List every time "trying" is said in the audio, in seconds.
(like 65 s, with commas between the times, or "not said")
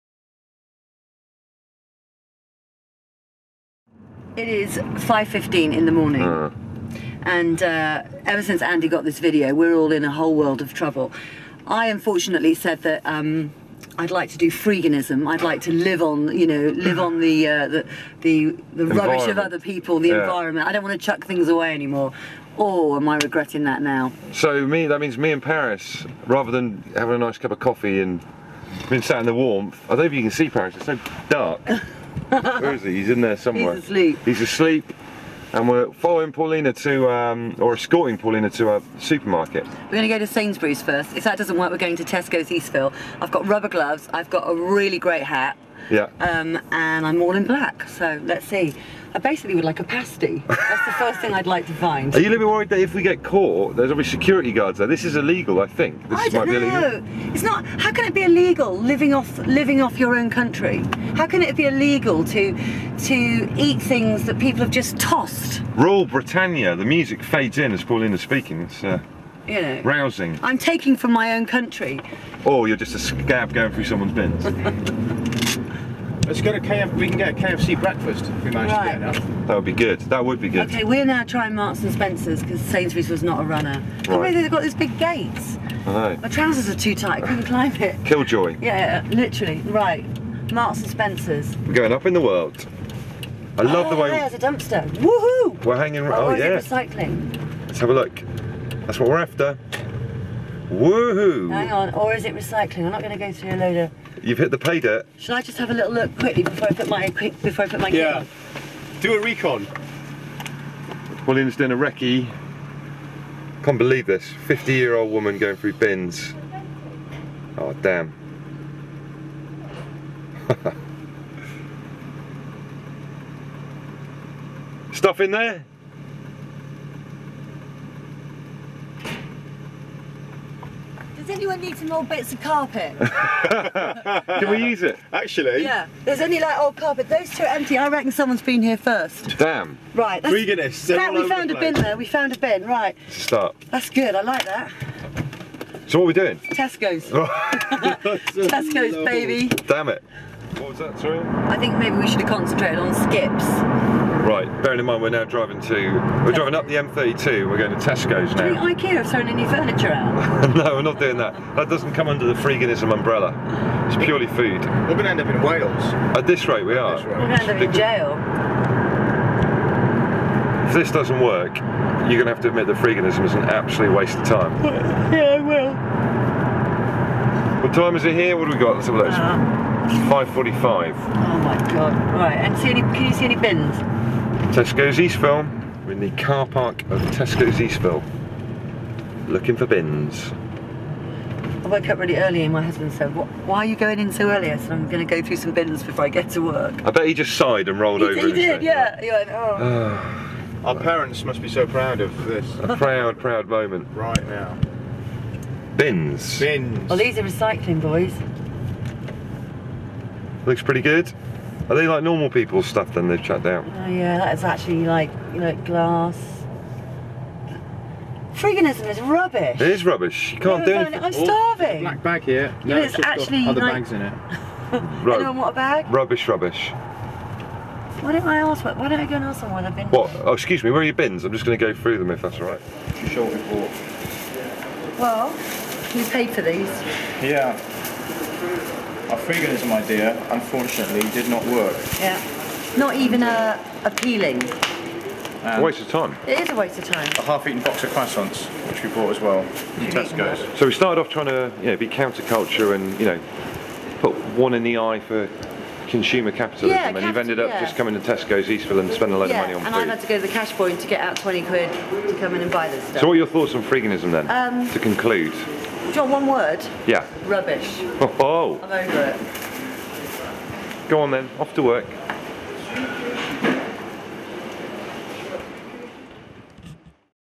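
81 s, 251 s.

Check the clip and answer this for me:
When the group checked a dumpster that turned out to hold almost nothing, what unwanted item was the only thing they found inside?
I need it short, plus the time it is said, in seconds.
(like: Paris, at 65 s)
Old carpet, at 131 s.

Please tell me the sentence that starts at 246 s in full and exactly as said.
It is a waste of time.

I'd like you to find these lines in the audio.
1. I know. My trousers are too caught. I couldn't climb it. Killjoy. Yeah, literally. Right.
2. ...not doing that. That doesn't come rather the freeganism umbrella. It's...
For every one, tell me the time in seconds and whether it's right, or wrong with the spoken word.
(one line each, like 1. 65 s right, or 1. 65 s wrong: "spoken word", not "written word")
1. 85 s wrong: "tight", not "caught"
2. 160 s wrong: "under", not "rather".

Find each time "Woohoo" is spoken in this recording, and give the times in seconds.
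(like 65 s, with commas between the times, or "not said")
94 s, 100 s.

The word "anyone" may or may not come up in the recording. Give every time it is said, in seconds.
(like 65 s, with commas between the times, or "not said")
131 s, 225 s.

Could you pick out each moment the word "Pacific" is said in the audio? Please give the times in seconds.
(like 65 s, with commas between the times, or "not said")
not said.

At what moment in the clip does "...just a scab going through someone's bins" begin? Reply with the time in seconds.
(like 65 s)
72 s.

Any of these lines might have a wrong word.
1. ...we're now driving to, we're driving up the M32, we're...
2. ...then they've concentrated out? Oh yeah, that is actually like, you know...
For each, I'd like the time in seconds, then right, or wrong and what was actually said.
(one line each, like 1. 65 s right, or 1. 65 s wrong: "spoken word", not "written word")
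1. 155 s right
2. 212 s wrong: "chucked", not "concentrated".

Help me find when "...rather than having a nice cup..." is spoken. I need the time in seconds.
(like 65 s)
26 s.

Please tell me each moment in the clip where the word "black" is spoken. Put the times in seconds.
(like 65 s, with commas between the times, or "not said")
47 s, 221 s.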